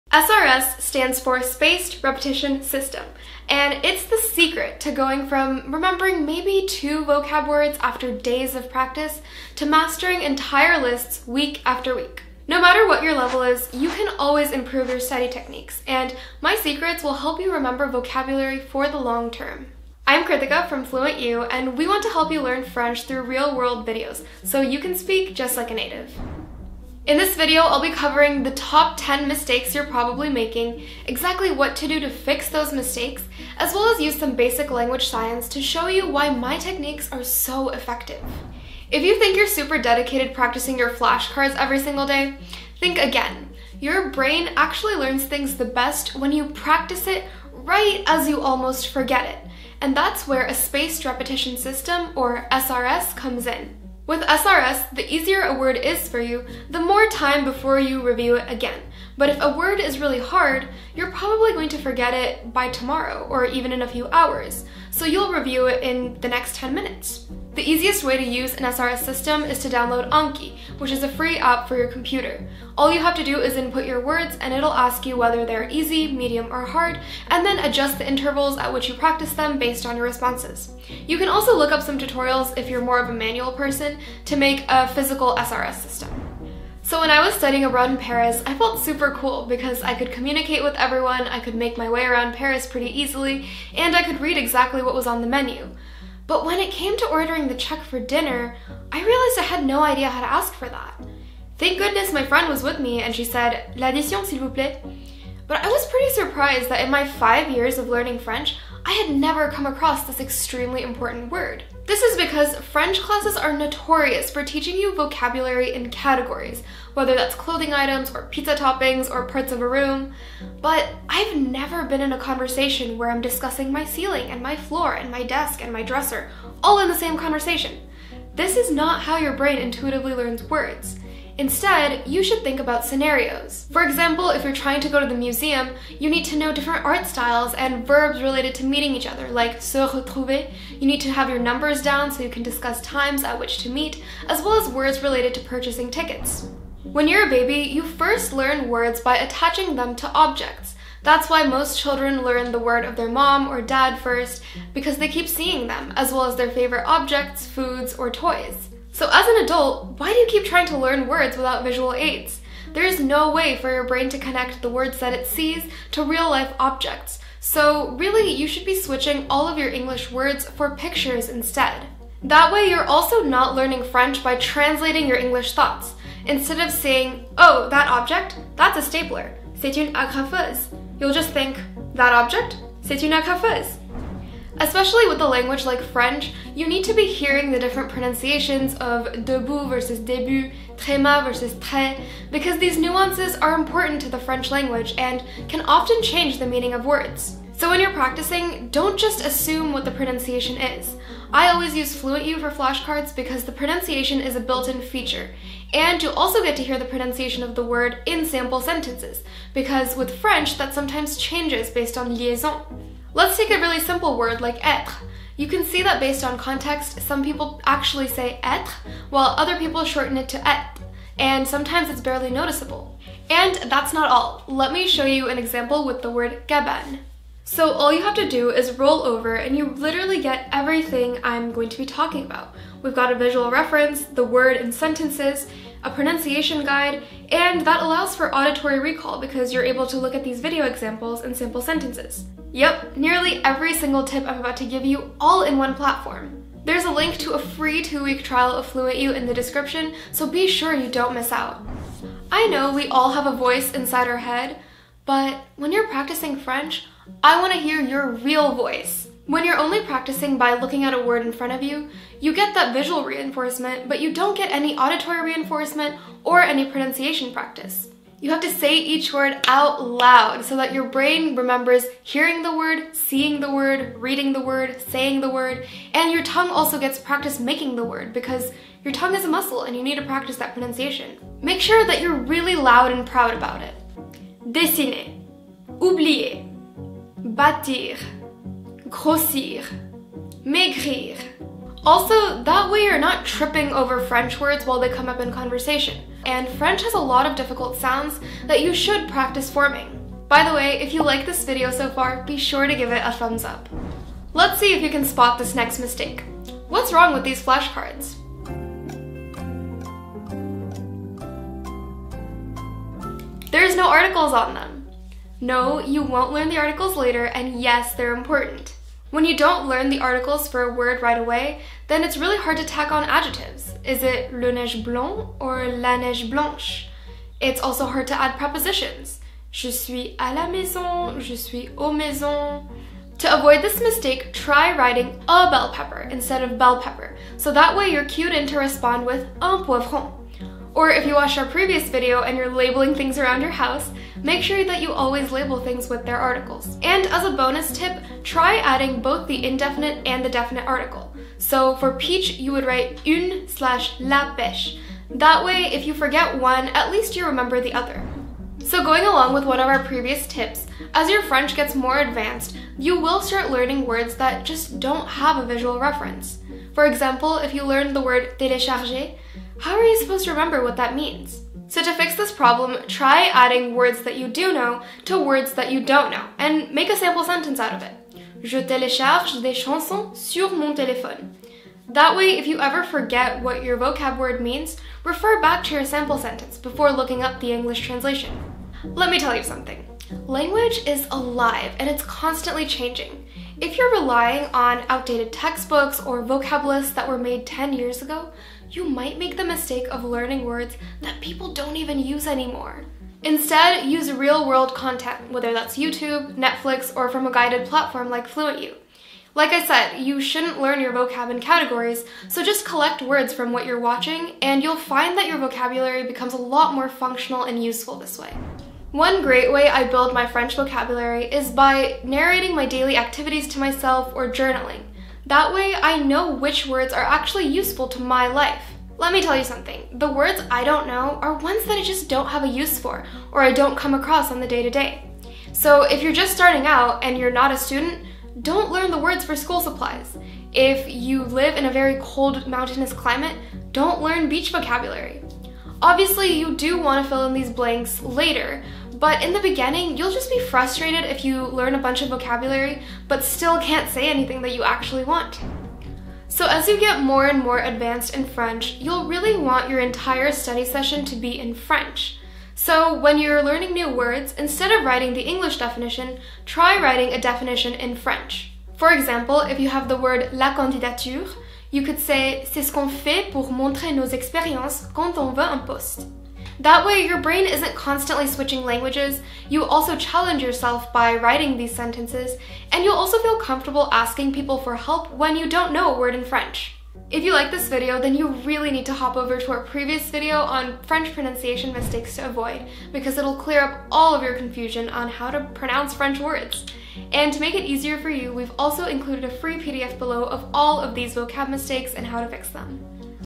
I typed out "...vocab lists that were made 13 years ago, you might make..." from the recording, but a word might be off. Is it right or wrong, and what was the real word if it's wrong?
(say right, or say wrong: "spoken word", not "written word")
wrong: "10", not "13".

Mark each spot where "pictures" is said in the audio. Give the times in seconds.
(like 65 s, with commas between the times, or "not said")
170 s.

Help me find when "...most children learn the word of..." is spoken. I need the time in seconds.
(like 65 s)
151 s.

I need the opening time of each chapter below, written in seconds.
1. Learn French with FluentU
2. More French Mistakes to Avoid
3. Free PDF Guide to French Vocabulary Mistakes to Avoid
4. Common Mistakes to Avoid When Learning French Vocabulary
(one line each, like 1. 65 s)
1. 184 s
2. 252 s
3. 487 s
4. 39 s.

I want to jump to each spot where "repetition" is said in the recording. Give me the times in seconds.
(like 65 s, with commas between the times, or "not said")
2 s, 51 s.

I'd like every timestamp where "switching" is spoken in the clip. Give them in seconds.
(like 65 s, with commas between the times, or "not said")
168 s, 478 s.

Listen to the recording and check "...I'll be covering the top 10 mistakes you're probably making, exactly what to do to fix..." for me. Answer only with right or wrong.
right.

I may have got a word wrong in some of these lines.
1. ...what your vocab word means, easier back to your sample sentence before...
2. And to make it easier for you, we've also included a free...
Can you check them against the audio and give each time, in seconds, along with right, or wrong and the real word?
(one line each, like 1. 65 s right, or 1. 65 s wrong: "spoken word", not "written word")
1. 383 s wrong: "refer", not "easier"
2. 497 s right.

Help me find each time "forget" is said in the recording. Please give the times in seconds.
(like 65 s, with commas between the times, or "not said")
48 s, 61 s, 355 s, 382 s.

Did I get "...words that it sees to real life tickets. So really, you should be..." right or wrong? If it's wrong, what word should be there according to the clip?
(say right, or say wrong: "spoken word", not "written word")
wrong: "objects", not "tickets".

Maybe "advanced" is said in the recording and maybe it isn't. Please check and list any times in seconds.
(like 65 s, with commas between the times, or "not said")
361 s, 457 s.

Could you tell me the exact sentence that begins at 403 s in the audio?
Instead, use real world content, whether that's YouTube, Netflix, or from a guided platform like FluentU.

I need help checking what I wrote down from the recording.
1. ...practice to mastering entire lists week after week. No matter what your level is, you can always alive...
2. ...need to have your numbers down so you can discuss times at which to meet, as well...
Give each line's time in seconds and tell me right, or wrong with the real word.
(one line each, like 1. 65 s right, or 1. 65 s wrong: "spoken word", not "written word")
1. 8 s wrong: "improve", not "alive"
2. 140 s right.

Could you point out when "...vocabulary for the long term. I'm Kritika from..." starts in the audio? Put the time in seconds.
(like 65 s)
17 s.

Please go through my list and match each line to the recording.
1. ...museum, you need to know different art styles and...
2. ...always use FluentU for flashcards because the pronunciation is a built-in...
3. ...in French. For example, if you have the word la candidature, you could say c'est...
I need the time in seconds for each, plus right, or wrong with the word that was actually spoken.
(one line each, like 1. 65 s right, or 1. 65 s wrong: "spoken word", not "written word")
1. 135 s right
2. 201 s right
3. 467 s right.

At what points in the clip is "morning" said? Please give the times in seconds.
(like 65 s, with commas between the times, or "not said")
not said.